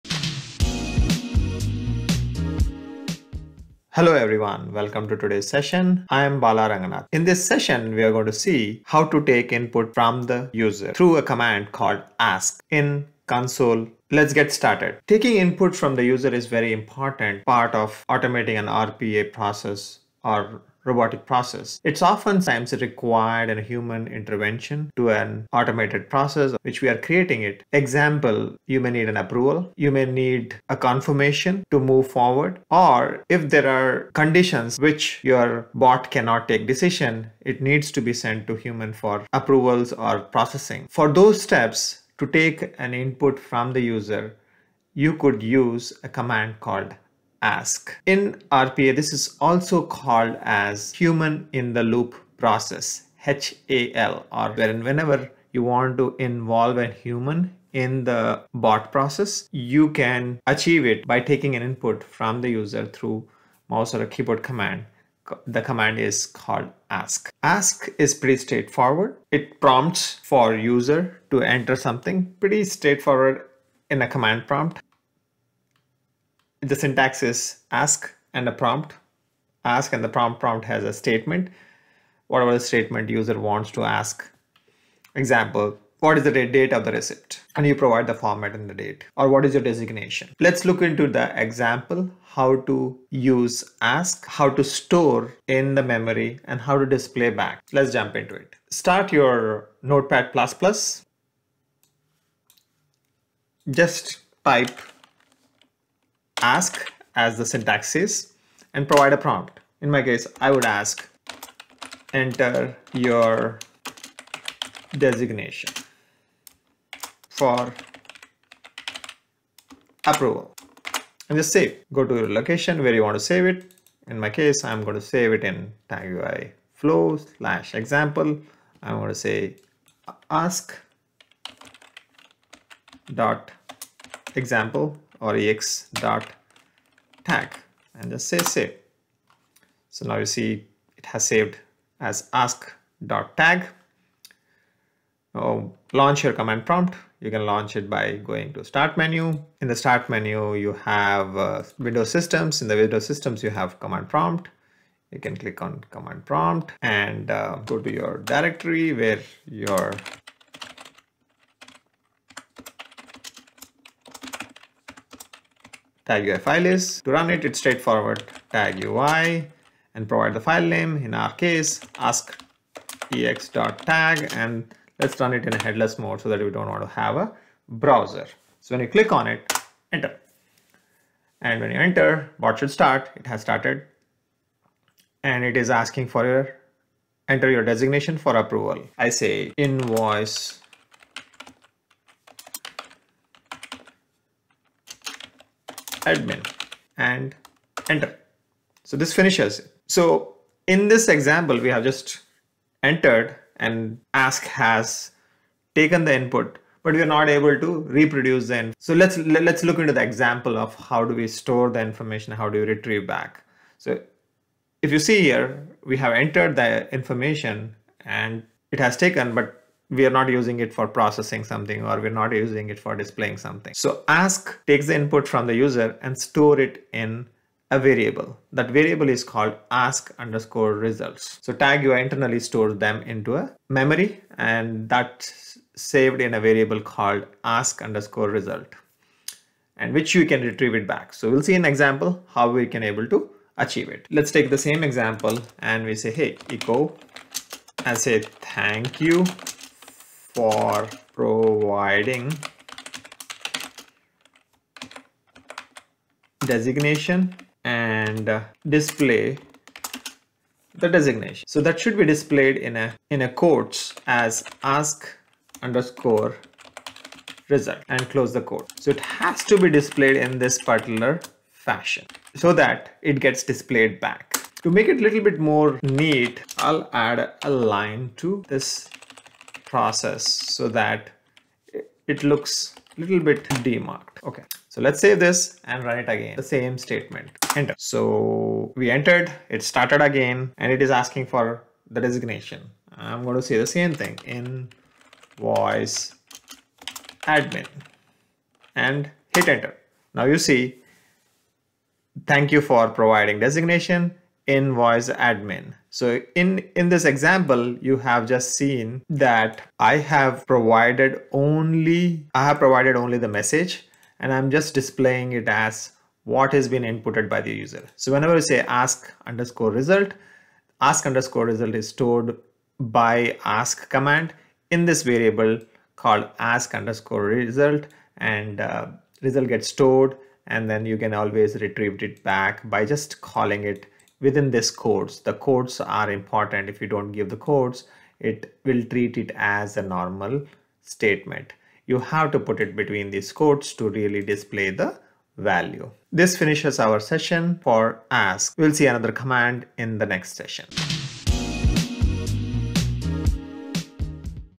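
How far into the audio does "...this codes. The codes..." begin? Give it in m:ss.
5:34.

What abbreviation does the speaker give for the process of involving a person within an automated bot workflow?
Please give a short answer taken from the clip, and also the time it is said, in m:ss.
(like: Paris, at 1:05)
HAL, at 0:53.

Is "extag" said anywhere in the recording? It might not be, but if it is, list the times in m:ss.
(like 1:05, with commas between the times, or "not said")
2:53.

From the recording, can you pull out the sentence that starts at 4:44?
Okay, so let's save this and run it again.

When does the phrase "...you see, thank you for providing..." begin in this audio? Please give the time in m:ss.
5:00.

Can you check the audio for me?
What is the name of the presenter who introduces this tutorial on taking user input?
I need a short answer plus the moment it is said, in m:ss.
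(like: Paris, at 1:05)
Bala Ranganath, at 0:06.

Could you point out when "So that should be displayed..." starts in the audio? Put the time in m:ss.
4:21.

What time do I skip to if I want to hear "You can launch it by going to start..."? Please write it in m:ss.
2:27.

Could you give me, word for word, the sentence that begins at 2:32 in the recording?
In the Windows systems, you have command prompt.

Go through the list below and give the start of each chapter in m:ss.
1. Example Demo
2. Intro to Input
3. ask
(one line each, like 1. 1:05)
1. 1:40
2. 0:15
3. 0:45.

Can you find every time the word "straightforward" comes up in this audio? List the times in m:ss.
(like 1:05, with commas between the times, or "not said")
1:08, 1:12, 2:47.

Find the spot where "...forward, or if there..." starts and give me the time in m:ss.
0:32.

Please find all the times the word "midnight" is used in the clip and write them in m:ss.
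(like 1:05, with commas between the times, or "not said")
not said.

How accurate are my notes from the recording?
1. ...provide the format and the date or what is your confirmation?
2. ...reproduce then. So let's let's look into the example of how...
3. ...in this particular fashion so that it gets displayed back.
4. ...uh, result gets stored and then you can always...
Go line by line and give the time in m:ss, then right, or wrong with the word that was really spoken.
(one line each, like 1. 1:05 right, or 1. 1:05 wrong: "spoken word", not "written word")
1. 1:27 wrong: "designation", not "confirmation"
2. 3:27 right
3. 4:30 right
4. 5:28 right.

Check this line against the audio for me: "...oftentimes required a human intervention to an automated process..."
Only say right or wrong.
right.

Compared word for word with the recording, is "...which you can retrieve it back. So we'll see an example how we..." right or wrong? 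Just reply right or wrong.
right.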